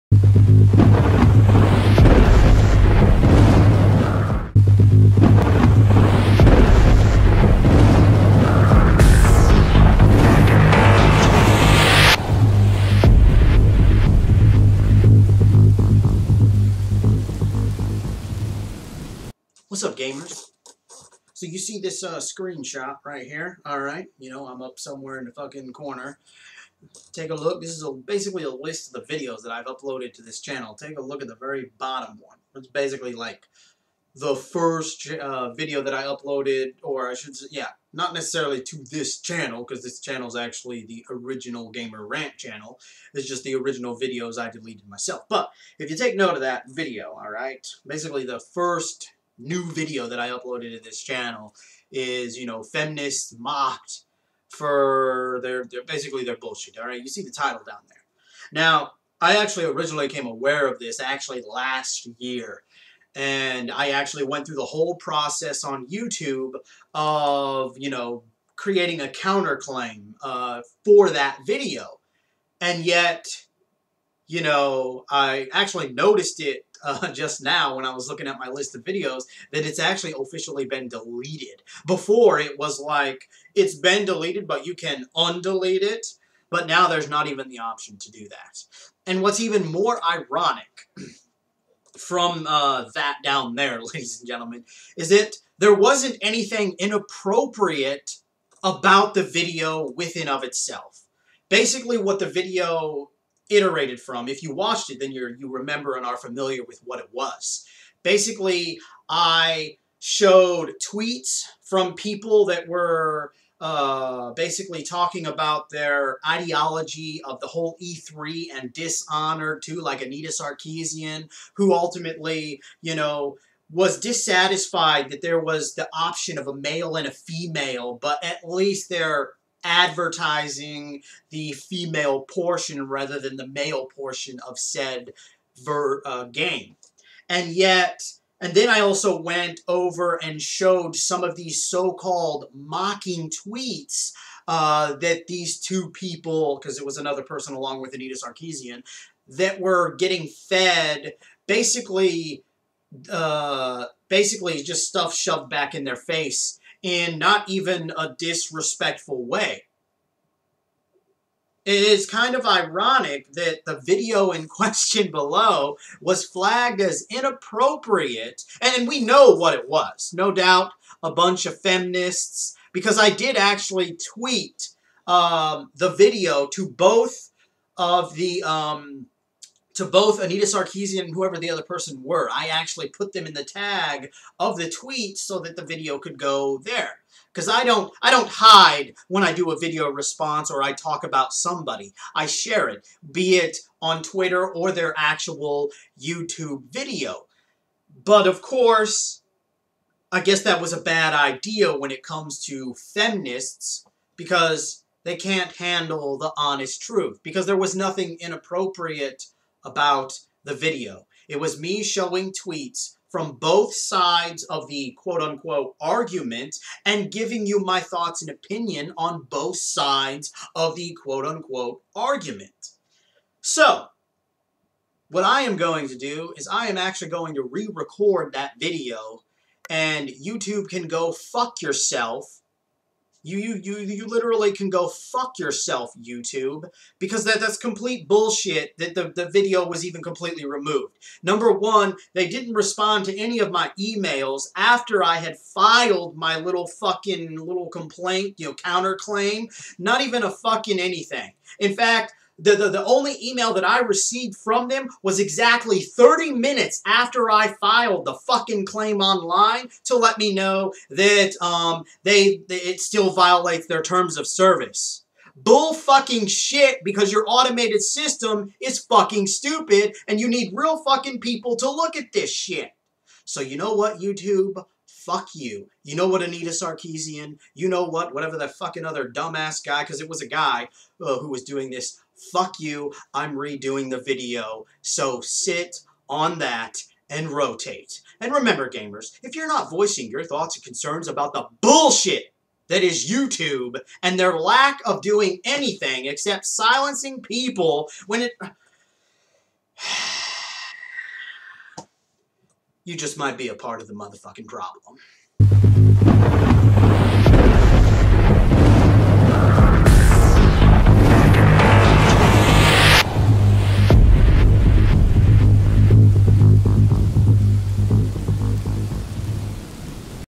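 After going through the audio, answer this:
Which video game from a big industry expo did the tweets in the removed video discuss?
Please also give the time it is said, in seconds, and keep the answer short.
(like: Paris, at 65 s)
Dishonored 2, at 118 s.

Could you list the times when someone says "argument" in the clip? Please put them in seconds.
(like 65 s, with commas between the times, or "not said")
215 s, 221 s.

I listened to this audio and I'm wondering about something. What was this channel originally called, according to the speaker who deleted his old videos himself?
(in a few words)
Gamer Rant.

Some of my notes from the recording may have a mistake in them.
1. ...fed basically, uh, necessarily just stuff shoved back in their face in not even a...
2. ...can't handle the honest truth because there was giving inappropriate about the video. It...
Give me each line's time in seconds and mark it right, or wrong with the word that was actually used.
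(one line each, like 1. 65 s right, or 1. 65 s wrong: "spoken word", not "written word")
1. 150 s wrong: "basically", not "necessarily"
2. 205 s wrong: "nothing", not "giving".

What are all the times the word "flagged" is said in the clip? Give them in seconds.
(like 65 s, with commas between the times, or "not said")
166 s.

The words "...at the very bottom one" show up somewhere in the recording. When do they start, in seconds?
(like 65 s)
31 s.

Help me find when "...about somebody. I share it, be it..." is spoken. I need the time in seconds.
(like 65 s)
191 s.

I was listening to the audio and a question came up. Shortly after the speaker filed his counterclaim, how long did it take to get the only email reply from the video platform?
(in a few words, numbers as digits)
30 minutes.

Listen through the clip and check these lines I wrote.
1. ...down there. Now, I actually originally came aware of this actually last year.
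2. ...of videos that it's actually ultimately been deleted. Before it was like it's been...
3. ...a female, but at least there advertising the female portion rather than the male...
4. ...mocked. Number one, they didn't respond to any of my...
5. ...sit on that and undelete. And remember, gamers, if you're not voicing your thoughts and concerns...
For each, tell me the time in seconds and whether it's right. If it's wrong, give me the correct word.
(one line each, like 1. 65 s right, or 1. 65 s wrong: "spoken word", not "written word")
1. 57 s right
2. 78 s wrong: "officially", not "ultimately"
3. 127 s right
4. 240 s wrong: "removed", not "mocked"
5. 285 s wrong: "rotate", not "undelete".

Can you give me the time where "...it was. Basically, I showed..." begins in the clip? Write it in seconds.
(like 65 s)
106 s.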